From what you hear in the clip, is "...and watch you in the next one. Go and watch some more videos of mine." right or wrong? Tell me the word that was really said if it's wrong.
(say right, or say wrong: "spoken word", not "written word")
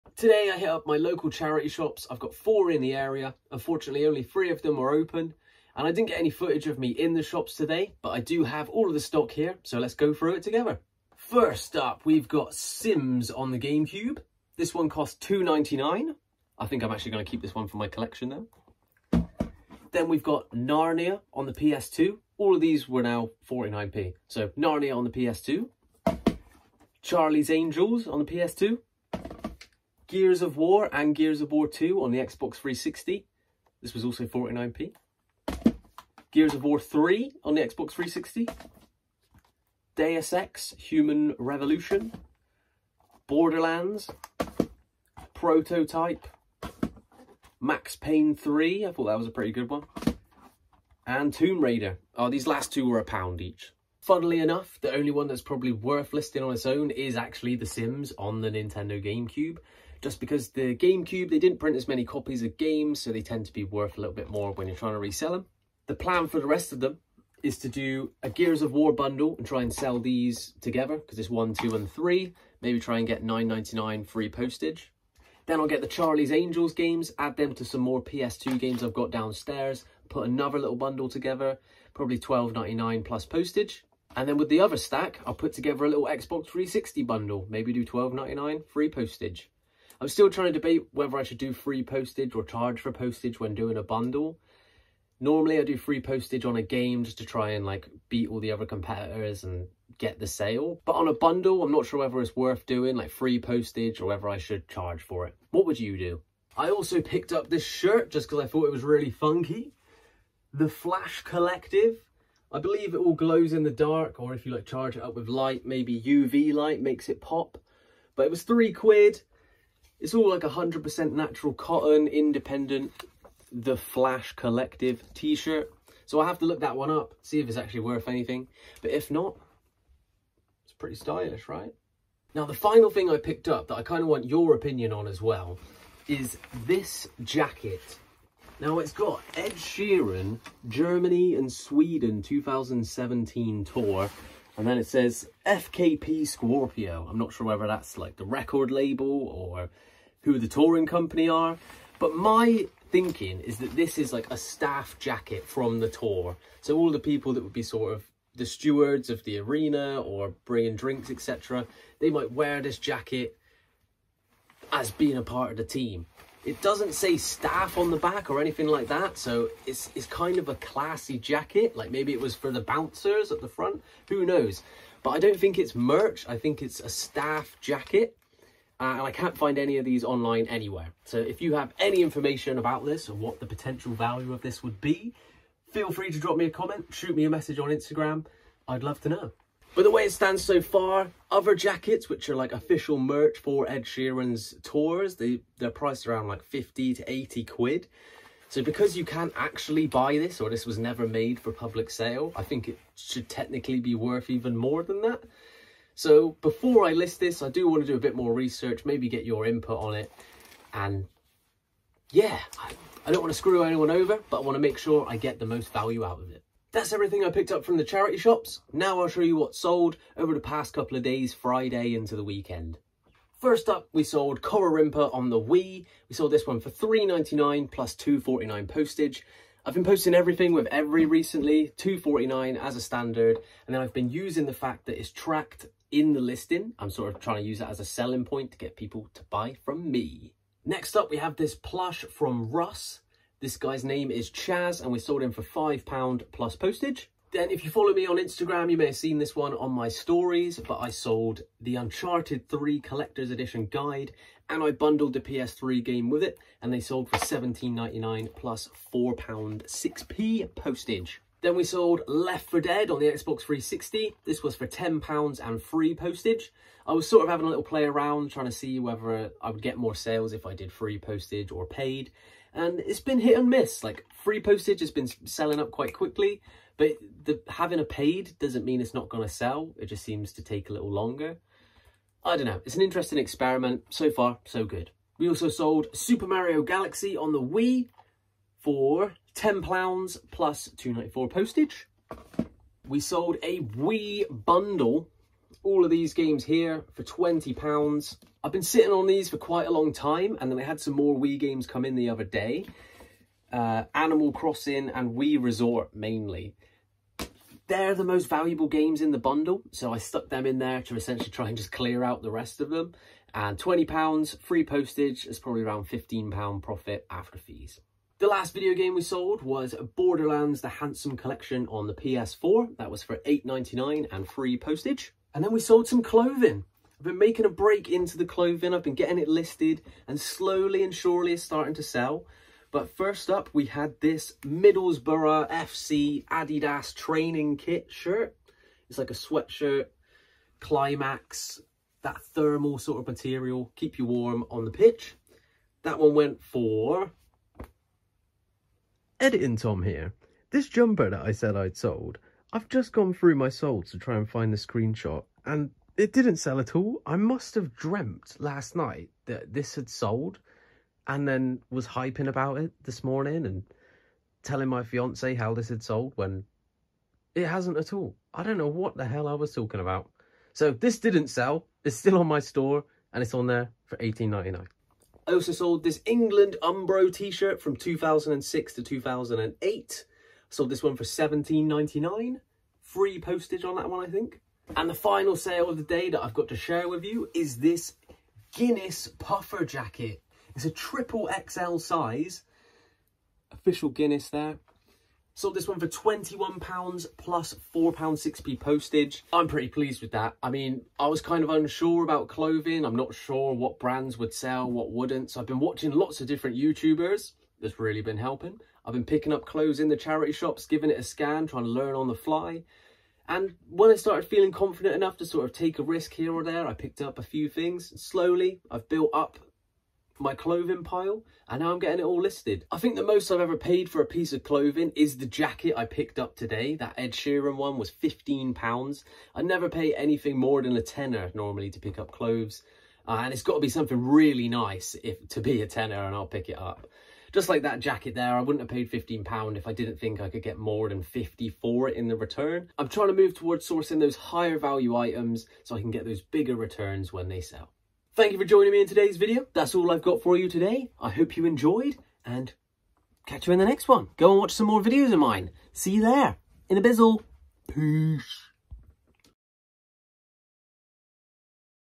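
wrong: "catch", not "watch".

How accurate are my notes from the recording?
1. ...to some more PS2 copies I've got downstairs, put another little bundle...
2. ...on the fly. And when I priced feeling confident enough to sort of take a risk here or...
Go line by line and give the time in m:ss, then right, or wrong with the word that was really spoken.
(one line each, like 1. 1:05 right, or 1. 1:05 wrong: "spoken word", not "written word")
1. 1:17 wrong: "games", not "copies"
2. 6:51 wrong: "started", not "priced".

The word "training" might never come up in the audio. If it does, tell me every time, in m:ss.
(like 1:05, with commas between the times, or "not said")
5:36.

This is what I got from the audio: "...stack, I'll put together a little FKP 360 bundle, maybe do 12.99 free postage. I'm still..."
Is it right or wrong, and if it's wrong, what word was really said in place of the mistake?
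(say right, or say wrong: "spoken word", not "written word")
wrong: "Xbox", not "FKP".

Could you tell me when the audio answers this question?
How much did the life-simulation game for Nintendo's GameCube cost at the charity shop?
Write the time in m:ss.
0:15.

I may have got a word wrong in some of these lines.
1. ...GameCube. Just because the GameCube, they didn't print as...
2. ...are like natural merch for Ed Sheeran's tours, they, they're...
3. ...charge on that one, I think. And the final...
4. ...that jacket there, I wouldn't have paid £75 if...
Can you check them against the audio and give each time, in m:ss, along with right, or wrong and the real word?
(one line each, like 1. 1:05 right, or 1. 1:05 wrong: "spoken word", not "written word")
1. 0:59 right
2. 3:12 wrong: "official", not "natural"
3. 6:23 wrong: "postage", not "charge"
4. 7:17 wrong: "15", not "75".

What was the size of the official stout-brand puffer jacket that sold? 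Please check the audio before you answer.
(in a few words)
triple XL.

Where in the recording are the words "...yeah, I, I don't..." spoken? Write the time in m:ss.
3:32.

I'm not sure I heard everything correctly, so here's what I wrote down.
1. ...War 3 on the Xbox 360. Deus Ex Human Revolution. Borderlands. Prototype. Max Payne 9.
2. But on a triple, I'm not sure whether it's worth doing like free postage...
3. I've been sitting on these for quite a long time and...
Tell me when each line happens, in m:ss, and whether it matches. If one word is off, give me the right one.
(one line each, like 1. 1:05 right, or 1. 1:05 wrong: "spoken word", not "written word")
1. 0:36 wrong: "3", not "9"
2. 1:40 wrong: "bundle", not "triple"
3. 4:58 right.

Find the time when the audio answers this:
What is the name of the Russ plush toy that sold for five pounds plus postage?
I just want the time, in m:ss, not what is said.
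4:04.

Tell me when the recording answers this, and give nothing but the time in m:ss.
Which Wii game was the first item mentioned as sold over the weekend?
3:44.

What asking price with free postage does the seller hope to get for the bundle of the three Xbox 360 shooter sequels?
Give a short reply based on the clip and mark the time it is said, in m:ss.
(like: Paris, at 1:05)
9.99, at 1:13.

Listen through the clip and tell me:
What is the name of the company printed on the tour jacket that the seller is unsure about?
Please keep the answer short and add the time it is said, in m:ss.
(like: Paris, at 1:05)
FKP Scorpio, at 2:25.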